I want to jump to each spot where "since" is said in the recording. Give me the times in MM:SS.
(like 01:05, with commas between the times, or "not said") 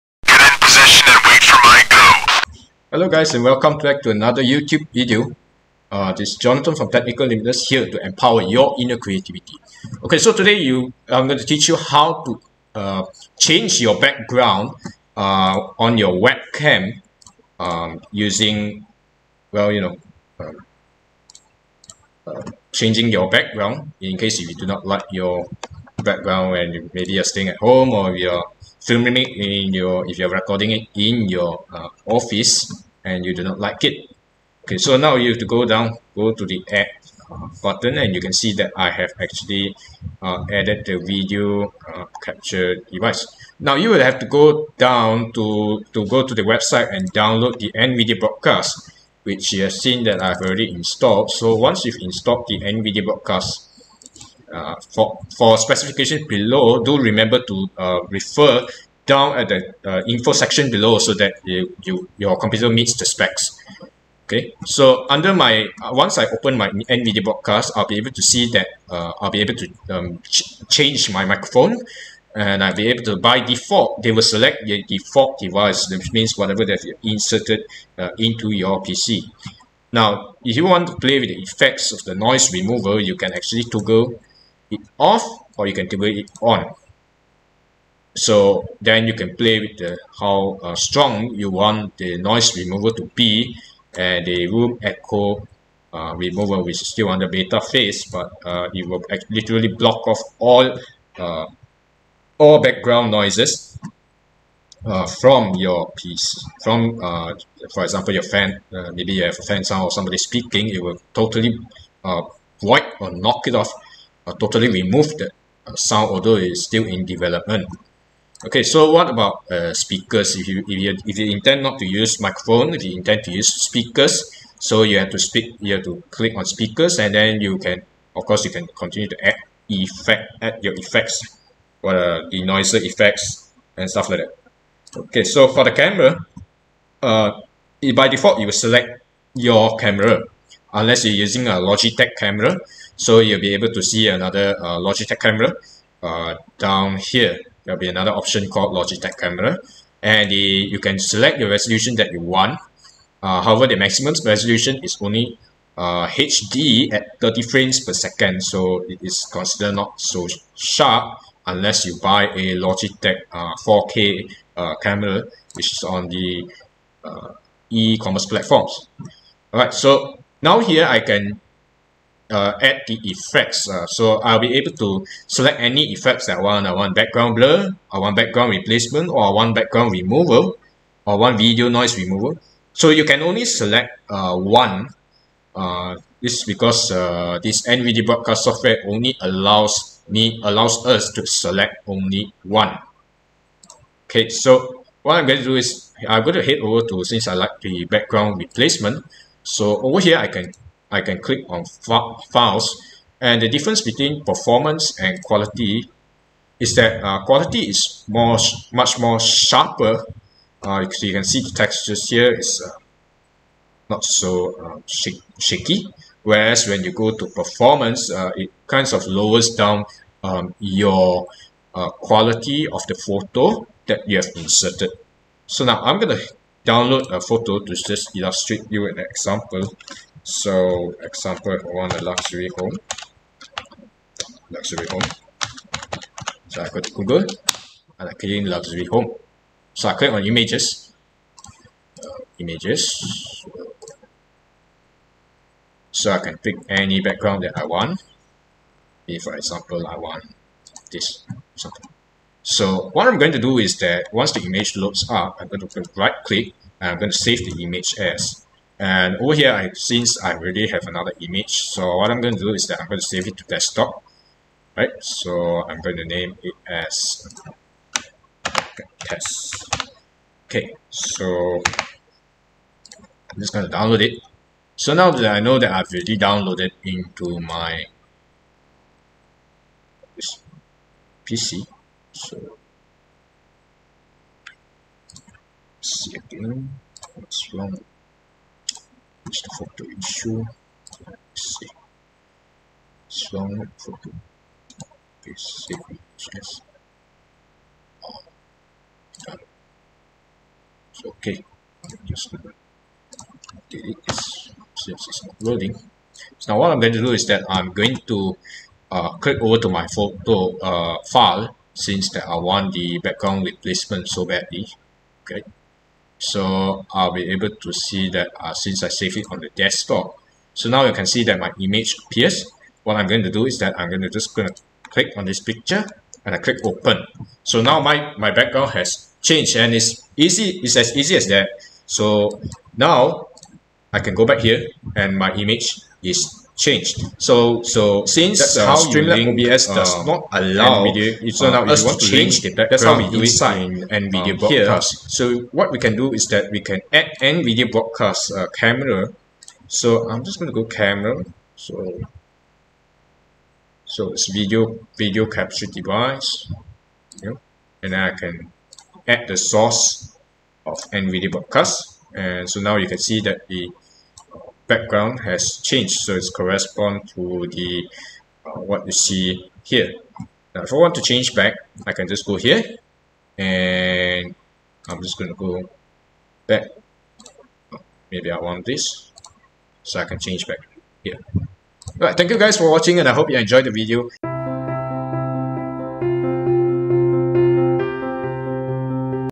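03:17, 04:19, 05:04, 05:11, 05:18, 05:38.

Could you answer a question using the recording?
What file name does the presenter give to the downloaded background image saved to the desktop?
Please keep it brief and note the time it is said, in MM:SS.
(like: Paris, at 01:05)
test, at 04:29.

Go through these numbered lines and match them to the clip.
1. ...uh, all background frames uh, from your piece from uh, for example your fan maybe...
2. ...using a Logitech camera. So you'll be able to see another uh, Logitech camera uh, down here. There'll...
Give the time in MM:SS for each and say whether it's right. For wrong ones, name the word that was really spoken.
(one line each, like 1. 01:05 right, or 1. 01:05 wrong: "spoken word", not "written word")
1. 01:41 wrong: "noises", not "frames"
2. 02:21 right.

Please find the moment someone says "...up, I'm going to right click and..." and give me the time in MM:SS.
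04:15.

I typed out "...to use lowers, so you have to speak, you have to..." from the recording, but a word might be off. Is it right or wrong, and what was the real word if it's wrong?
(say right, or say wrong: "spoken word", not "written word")
wrong: "speakers", not "lowers".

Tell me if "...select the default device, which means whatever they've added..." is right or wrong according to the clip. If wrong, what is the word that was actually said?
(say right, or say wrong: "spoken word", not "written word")
wrong: "inserted", not "added".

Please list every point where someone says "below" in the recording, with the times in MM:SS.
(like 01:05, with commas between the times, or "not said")
00:56, 01:00.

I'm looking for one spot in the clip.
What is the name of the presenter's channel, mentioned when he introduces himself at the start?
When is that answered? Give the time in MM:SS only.
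00:06.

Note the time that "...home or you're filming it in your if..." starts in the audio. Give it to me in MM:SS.
00:27.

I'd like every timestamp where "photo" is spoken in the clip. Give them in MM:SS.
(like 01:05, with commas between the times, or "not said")
03:42, 03:47, 04:49, 04:53, 05:09.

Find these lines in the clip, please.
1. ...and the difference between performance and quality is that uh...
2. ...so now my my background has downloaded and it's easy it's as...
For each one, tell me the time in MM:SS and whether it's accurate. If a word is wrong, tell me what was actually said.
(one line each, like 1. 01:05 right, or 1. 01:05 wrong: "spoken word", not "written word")
1. 03:23 right
2. 05:27 wrong: "changed", not "downloaded".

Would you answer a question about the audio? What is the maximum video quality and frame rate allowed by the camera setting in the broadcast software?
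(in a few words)
HD at 30 frames per second.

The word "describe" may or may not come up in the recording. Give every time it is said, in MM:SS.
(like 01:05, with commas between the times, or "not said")
not said.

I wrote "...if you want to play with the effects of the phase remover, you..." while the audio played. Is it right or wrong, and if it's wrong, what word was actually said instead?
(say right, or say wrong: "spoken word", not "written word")
wrong: "noise", not "phase".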